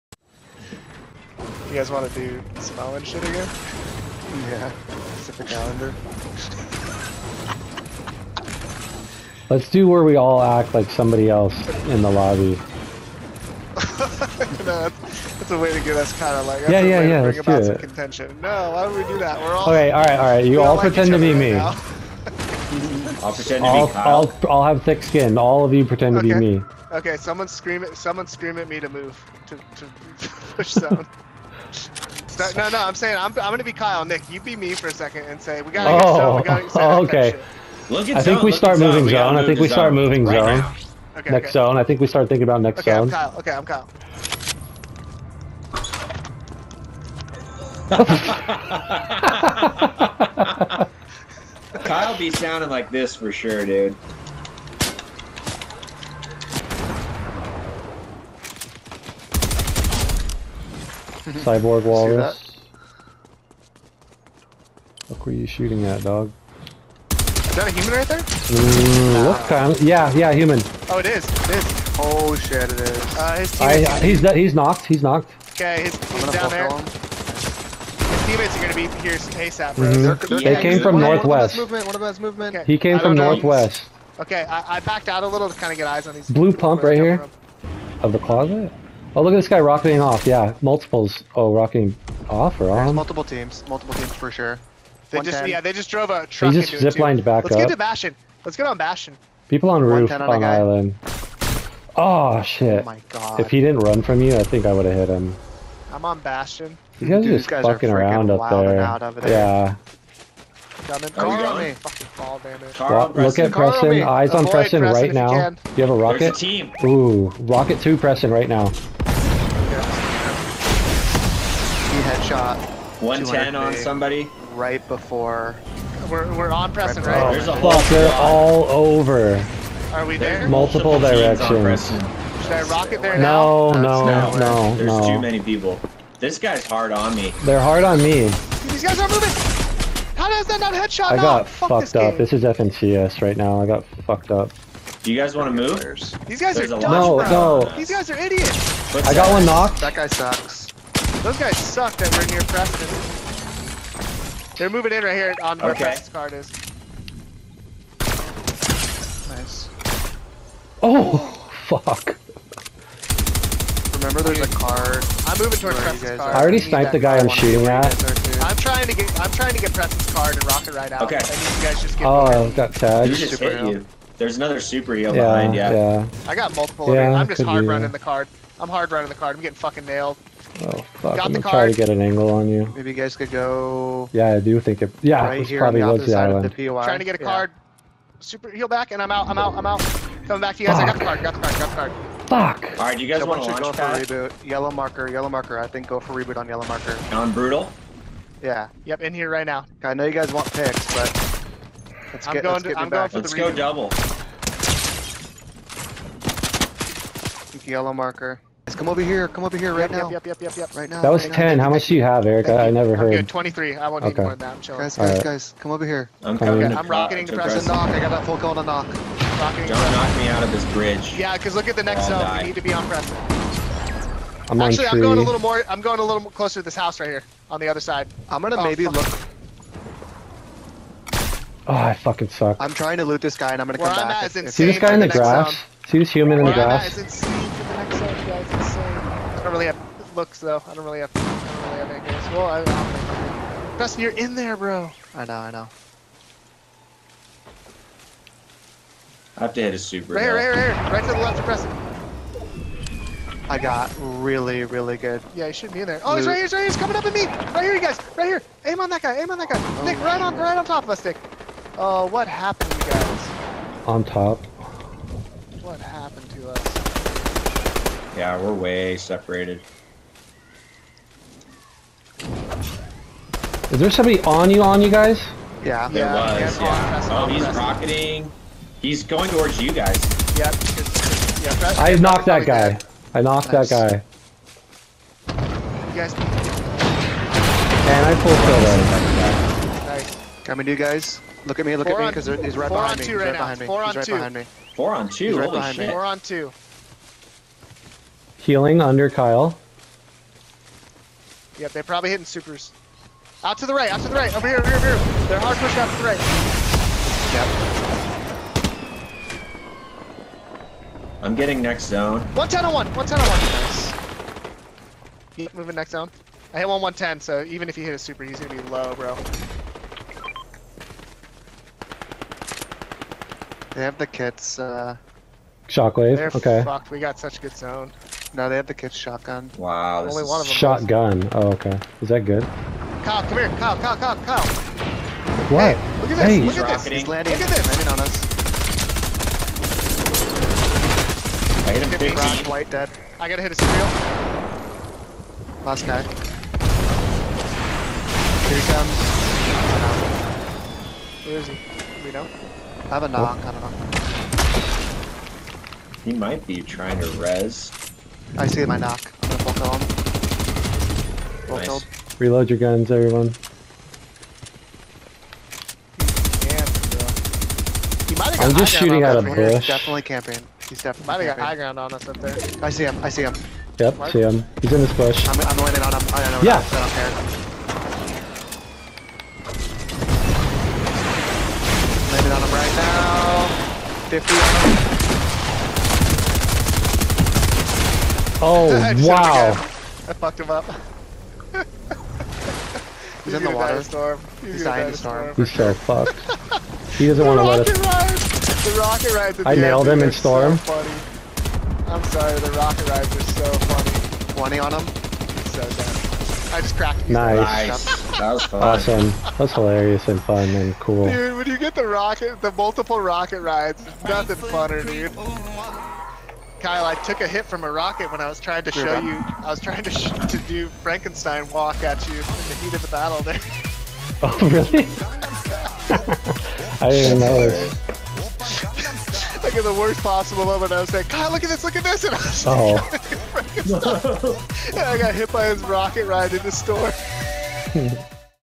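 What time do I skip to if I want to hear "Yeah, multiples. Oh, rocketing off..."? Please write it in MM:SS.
01:30.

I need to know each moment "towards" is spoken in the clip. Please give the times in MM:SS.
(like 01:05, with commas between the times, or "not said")
02:45, 04:39.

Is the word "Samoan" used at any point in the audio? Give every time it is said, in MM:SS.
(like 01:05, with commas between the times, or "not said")
00:02.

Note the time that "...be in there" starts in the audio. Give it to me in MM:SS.
04:15.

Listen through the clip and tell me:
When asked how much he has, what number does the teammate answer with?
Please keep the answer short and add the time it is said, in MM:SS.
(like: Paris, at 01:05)
23, at 03:33.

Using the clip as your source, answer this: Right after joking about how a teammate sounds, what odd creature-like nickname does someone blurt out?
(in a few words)
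Cyborg walrus.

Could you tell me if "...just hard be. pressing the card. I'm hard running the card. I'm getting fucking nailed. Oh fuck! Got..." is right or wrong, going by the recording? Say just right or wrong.
wrong.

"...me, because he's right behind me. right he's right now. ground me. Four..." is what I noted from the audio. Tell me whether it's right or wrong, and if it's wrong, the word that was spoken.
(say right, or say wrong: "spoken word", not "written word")
wrong: "behind", not "ground".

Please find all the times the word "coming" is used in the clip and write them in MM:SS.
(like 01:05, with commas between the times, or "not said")
01:51, 03:10, 03:36, 04:16, 04:50.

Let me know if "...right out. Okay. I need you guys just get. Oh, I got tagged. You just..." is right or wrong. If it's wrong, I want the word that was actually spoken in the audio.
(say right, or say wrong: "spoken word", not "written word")
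right.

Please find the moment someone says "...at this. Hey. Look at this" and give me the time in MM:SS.
05:36.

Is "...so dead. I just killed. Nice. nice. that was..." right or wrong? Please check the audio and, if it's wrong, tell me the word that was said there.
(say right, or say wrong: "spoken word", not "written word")
wrong: "cracked", not "killed".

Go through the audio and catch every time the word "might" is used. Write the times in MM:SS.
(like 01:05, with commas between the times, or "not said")
05:56, 06:11.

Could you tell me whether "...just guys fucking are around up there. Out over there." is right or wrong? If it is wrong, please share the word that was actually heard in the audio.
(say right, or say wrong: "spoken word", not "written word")
right.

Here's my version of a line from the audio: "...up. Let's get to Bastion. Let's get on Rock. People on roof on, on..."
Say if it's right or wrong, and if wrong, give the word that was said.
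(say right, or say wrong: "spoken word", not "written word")
wrong: "Bastion", not "Rock".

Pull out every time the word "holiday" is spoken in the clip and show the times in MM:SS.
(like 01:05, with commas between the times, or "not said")
not said.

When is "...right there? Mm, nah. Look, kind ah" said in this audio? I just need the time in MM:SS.
01:07.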